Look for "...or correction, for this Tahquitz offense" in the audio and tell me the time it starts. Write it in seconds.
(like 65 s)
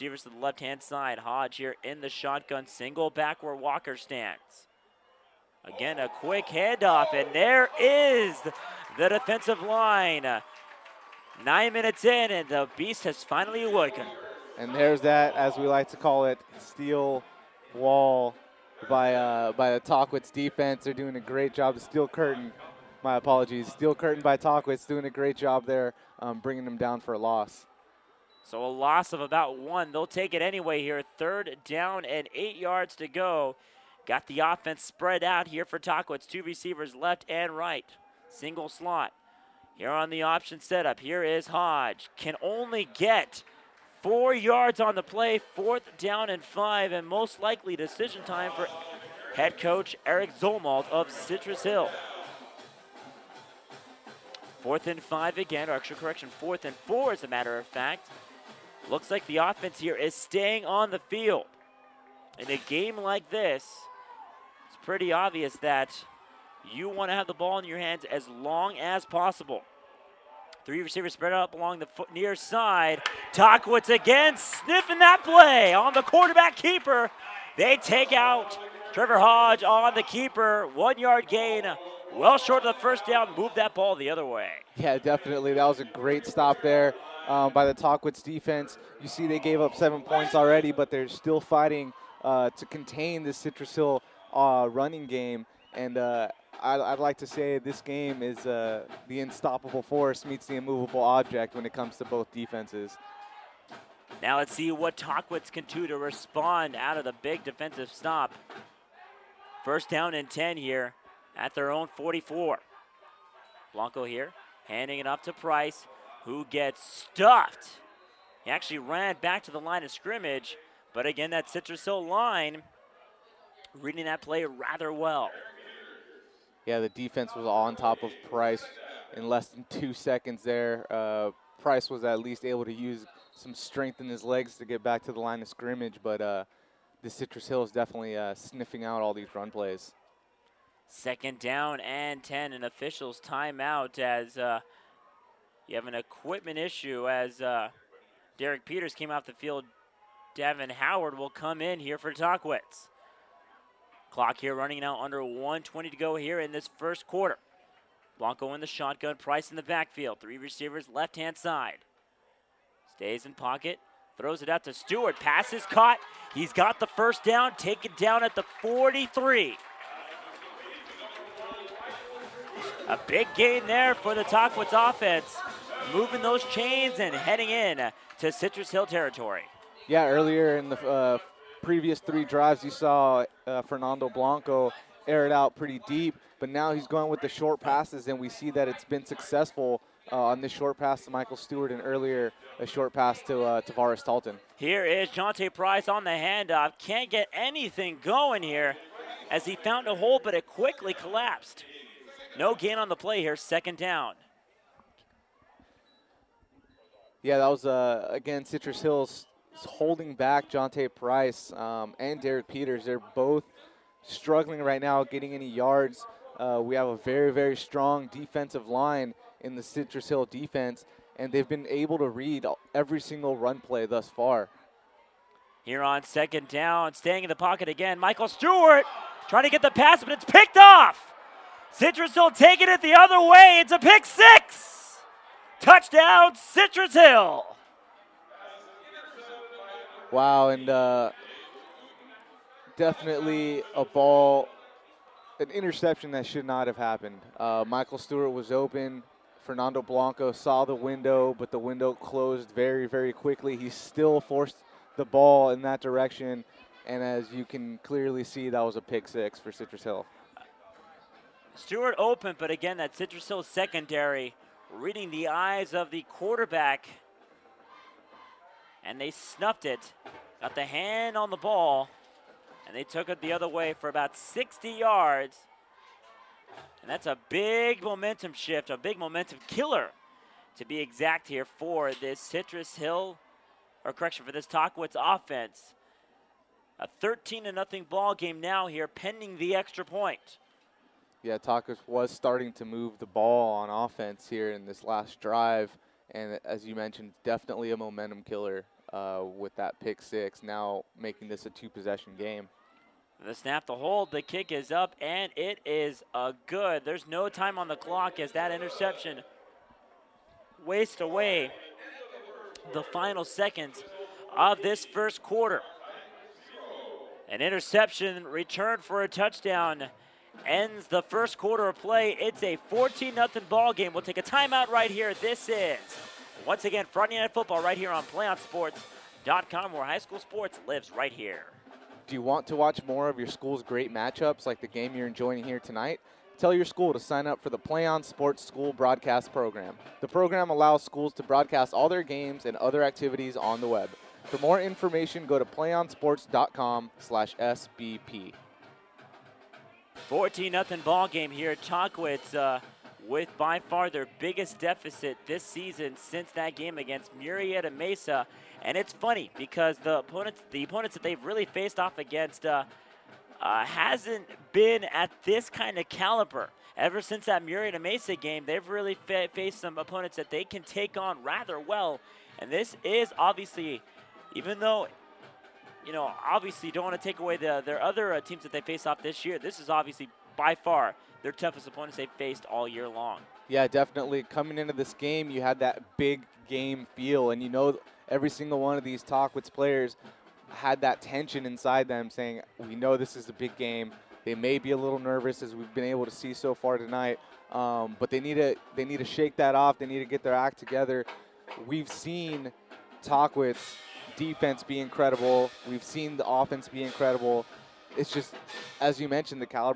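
283 s.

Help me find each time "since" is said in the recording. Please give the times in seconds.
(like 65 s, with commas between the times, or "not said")
355 s, 367 s.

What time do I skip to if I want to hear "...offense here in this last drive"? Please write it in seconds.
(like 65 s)
293 s.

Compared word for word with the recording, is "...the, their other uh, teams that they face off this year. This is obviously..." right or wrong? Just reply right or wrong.
right.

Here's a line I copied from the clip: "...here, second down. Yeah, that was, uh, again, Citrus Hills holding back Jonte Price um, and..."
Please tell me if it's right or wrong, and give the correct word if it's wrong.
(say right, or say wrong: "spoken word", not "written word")
right.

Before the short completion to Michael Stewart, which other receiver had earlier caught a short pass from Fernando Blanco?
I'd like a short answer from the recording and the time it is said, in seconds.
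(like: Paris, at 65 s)
Tavares Talton, at 193 s.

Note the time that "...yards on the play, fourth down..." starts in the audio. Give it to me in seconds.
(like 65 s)
44 s.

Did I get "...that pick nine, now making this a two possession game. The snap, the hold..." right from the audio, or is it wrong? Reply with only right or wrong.
wrong.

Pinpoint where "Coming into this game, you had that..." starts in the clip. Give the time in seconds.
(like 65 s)
384 s.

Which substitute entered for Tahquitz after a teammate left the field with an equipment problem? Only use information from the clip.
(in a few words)
Devin Howard.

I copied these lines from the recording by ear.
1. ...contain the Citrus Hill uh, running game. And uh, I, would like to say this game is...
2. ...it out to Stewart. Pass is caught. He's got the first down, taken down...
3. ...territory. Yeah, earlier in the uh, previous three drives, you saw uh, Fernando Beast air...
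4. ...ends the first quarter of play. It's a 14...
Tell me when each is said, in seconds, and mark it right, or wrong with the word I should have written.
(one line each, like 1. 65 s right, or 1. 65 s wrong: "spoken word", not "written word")
1. 92 s right
2. 164 s right
3. 178 s wrong: "Blanco", not "Beast"
4. 320 s right.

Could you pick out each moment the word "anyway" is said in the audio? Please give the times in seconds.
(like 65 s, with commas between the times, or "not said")
30 s.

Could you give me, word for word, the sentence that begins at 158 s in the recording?
Blanco in the shotgun, Price in the backfield.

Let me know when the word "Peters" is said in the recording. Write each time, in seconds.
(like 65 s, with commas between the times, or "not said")
148 s, 212 s.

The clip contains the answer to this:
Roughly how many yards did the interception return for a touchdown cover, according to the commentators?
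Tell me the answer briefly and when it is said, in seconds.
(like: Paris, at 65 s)
60, at 273 s.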